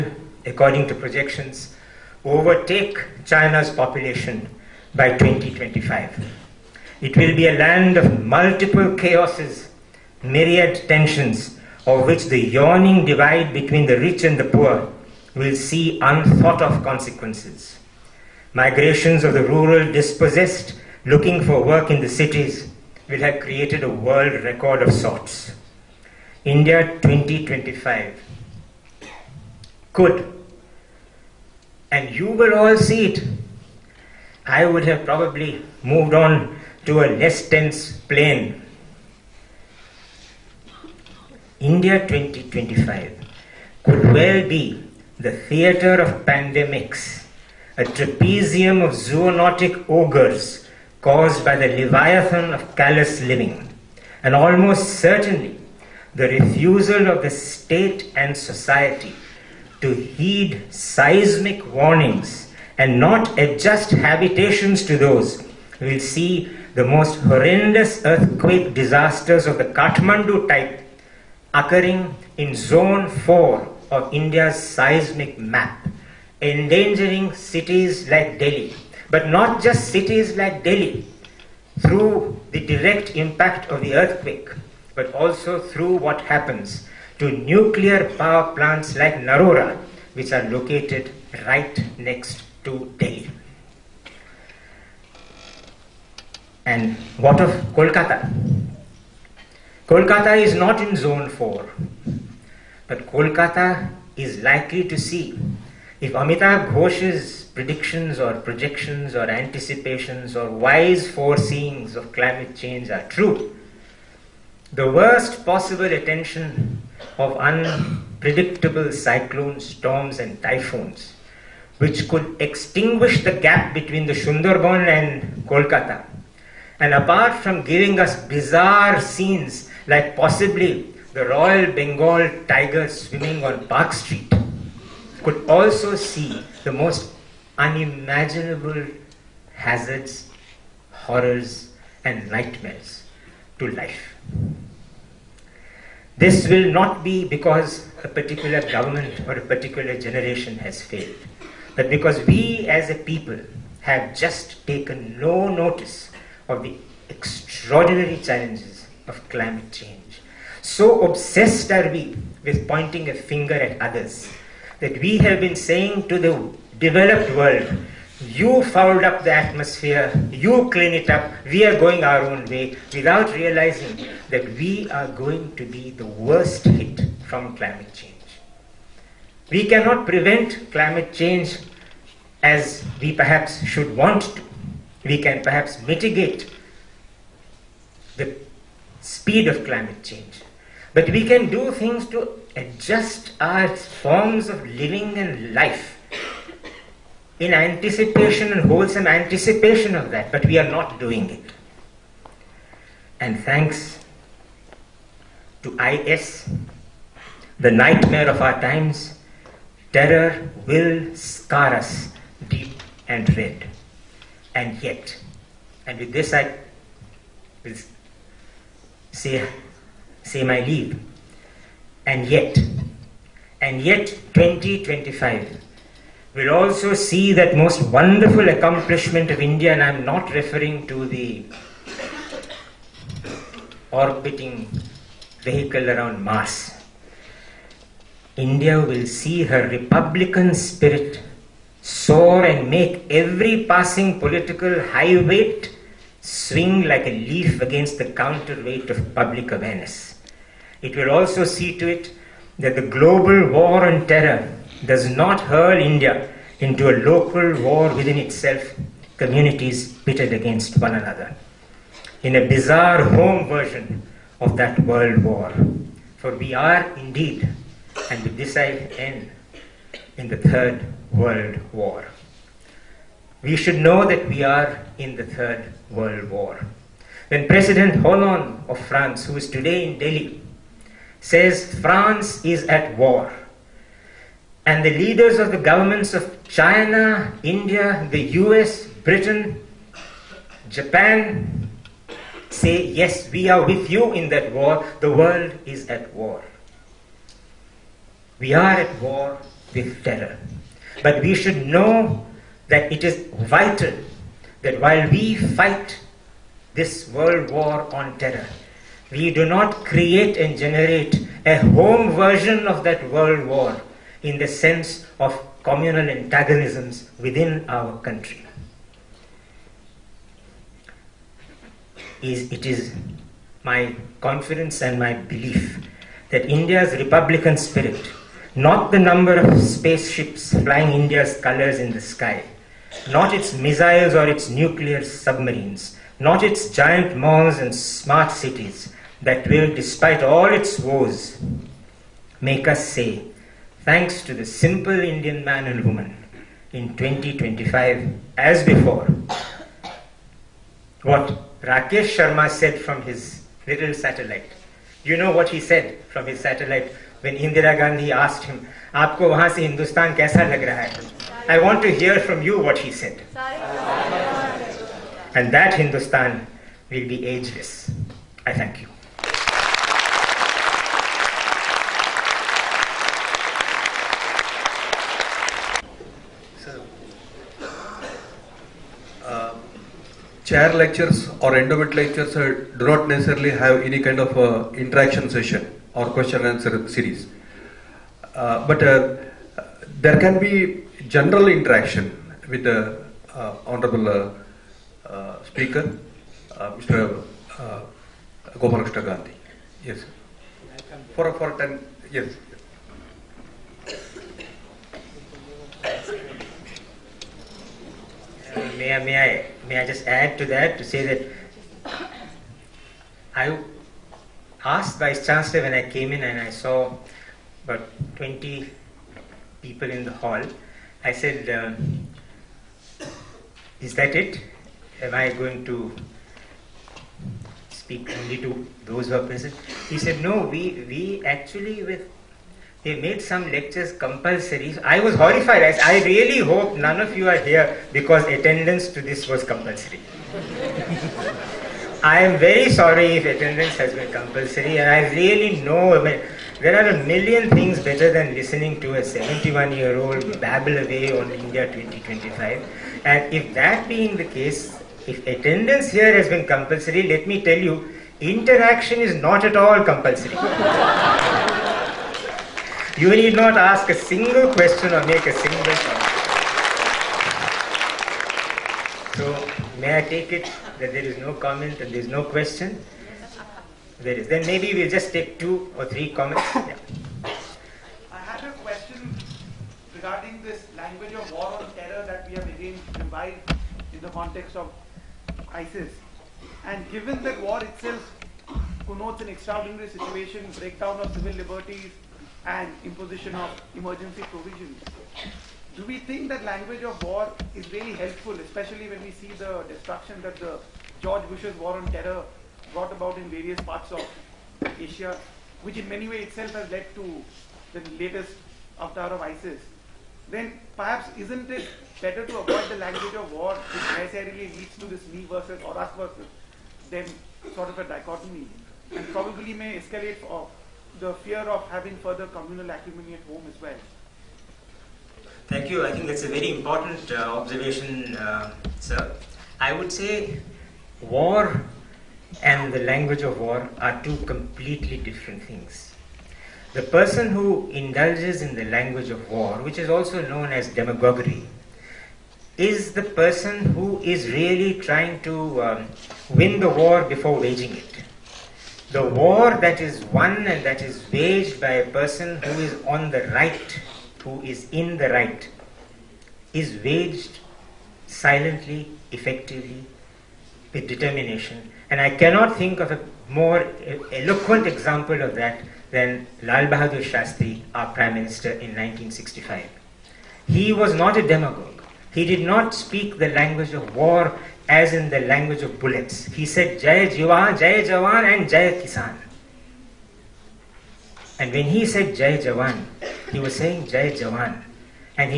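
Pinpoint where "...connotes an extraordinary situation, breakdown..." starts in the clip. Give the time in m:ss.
8:08.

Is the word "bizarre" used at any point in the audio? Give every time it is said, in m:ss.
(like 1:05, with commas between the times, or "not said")
2:08, 4:22.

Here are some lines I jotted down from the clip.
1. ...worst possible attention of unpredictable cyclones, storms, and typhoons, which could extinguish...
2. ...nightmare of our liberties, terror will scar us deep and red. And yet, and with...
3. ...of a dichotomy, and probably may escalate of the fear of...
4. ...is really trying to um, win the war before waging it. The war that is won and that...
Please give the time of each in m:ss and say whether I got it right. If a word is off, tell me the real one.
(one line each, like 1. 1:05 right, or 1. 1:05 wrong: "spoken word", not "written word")
1. 1:54 right
2. 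3:27 wrong: "times", not "liberties"
3. 8:37 right
4. 9:04 right.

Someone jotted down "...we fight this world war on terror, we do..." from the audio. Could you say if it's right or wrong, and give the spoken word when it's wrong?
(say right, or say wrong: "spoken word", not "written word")
right.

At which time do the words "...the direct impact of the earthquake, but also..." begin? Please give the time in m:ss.
1:22.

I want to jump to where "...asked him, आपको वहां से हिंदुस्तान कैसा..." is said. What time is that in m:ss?
5:58.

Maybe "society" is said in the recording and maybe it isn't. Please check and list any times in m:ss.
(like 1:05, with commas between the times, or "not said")
0:58.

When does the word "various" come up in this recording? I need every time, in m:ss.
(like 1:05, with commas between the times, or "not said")
8:23.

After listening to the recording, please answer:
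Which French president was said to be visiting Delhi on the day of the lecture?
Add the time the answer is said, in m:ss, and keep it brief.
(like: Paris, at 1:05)
Hollande, at 4:38.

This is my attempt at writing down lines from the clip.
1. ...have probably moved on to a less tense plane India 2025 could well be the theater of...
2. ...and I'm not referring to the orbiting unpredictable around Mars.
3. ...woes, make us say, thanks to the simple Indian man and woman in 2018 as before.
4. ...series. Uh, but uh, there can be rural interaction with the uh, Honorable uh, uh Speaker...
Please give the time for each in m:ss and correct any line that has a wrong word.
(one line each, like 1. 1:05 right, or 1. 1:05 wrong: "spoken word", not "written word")
1. 0:34 right
2. 3:49 wrong: "vehicle", not "unpredictable"
3. 5:40 wrong: "2025", not "2018"
4. 6:26 wrong: "general", not "rural".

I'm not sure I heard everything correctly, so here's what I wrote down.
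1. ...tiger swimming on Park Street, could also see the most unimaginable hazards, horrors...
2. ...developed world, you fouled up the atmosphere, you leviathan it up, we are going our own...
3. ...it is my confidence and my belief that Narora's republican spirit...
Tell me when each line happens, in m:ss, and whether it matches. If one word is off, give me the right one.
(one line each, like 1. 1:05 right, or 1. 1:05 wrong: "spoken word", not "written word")
1. 2:12 right
2. 2:46 wrong: "clean", not "leviathan"
3. 5:22 wrong: "India", not "Narora".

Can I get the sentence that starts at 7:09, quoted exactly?
He said, No, we, we actually, with they made some lectures compulsory.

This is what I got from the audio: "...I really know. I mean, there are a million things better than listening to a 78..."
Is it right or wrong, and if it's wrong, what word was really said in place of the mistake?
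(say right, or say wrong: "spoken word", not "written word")
wrong: "71", not "78".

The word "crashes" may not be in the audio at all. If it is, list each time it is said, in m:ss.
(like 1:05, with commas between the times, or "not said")
not said.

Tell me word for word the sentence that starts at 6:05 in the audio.
And that Hindustan will be ageless.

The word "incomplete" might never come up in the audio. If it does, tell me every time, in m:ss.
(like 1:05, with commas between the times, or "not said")
not said.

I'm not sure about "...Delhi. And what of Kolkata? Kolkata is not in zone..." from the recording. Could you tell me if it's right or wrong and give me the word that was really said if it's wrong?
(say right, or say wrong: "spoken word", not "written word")
right.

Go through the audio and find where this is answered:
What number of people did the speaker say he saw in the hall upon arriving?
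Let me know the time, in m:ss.
6:58.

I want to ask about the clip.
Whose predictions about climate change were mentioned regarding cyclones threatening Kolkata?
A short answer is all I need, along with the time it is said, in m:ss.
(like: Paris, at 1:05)
Amitav Ghosh, at 1:46.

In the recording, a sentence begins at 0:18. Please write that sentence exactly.
Migrations of the rural dispossessed looking for work in the cities will have created a world record of sorts.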